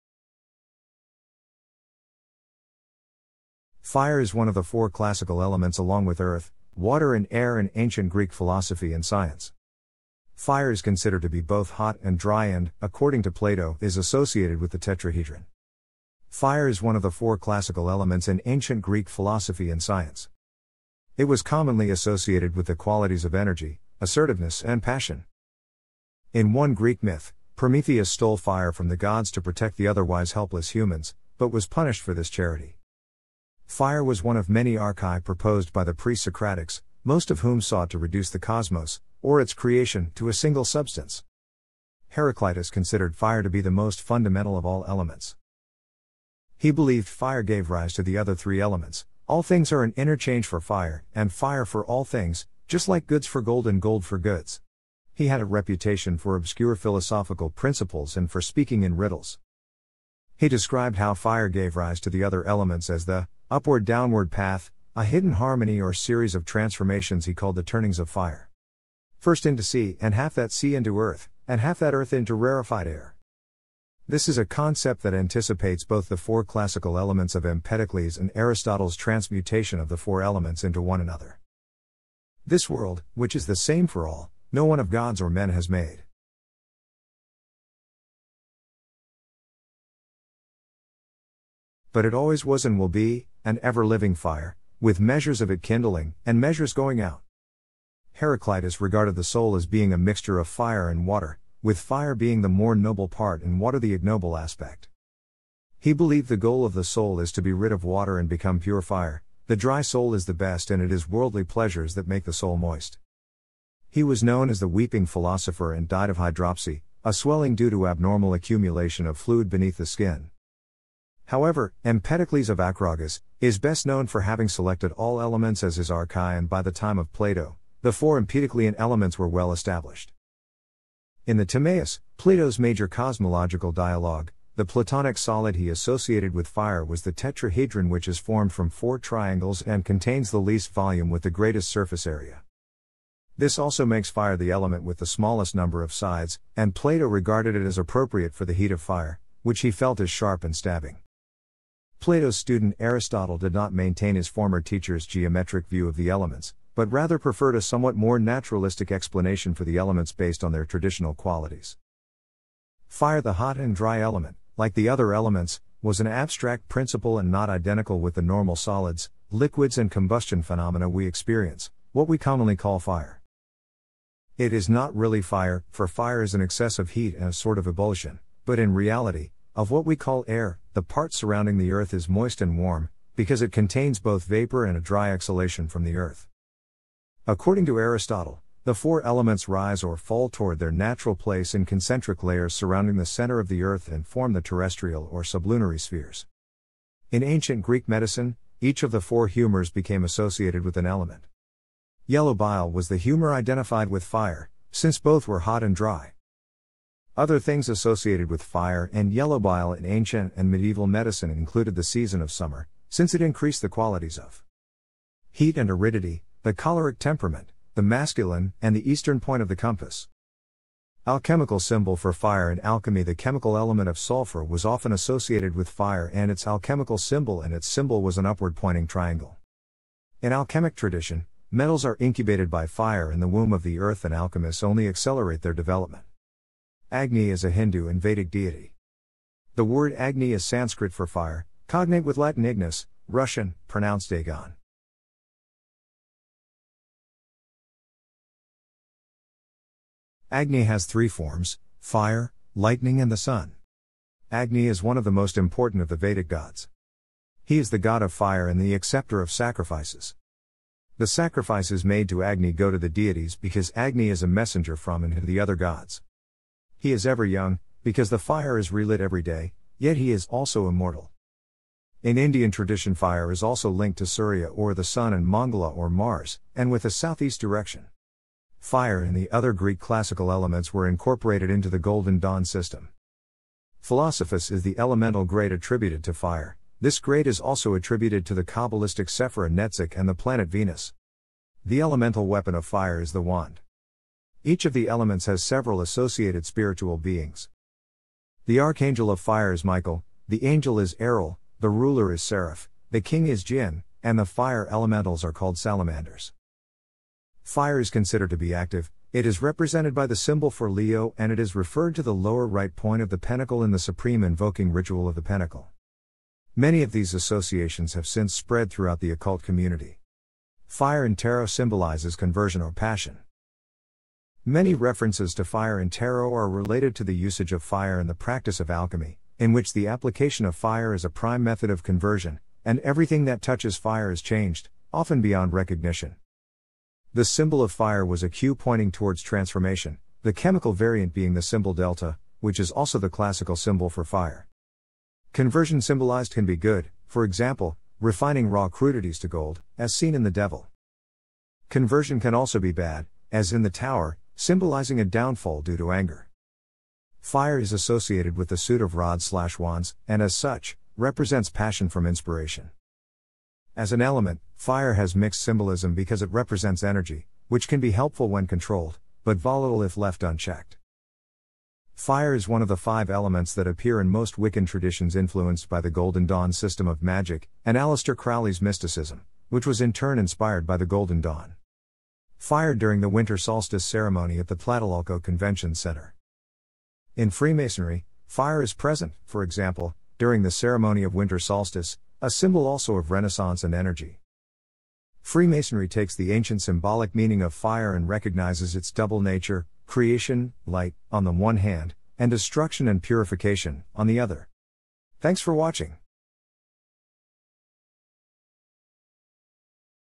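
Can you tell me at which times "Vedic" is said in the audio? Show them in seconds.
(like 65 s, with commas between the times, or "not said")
238 s, 255 s.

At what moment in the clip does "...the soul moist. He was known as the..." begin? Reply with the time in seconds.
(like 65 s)
112 s.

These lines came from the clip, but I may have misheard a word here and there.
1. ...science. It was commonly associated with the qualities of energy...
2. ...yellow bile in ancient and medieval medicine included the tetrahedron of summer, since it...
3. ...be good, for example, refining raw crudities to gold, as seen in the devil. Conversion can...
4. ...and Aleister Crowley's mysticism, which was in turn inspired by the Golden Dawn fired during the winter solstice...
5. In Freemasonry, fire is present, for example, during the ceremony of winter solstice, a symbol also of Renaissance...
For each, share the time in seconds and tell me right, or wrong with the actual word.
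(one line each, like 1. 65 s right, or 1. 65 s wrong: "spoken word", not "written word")
1. 19 s right
2. 209 s wrong: "season", not "tetrahedron"
3. 346 s right
4. 377 s right
5. 387 s right.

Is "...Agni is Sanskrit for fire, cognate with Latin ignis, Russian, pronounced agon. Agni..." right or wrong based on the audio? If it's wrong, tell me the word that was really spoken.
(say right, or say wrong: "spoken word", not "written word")
right.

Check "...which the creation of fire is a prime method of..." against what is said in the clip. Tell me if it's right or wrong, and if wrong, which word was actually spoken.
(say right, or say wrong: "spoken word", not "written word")
wrong: "application", not "creation".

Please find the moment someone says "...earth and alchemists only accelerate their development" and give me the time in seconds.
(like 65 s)
233 s.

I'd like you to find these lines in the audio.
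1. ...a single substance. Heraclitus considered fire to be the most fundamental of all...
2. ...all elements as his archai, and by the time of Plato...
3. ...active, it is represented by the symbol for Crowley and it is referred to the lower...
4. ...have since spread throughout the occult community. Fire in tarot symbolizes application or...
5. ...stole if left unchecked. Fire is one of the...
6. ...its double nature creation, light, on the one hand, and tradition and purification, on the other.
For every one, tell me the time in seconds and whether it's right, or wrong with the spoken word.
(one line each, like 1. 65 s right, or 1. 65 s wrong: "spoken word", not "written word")
1. 40 s right
2. 124 s right
3. 308 s wrong: "Leo", not "Crowley"
4. 317 s wrong: "conversion", not "application"
5. 369 s wrong: "volatile", not "stole"
6. 398 s wrong: "destruction", not "tradition".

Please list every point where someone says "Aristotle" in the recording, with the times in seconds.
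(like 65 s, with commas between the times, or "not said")
78 s, 152 s, 187 s.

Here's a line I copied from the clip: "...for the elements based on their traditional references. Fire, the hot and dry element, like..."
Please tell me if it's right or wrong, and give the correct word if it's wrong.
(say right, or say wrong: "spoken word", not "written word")
wrong: "qualities", not "references".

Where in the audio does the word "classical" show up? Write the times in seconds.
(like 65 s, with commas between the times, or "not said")
4 s, 17 s, 76 s, 279 s, 343 s.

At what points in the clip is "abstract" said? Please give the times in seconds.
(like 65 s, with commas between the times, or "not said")
166 s.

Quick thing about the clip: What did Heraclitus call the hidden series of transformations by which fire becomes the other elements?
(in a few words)
the turnings of fire.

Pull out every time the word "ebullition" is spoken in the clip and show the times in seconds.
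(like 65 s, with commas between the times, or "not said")
177 s.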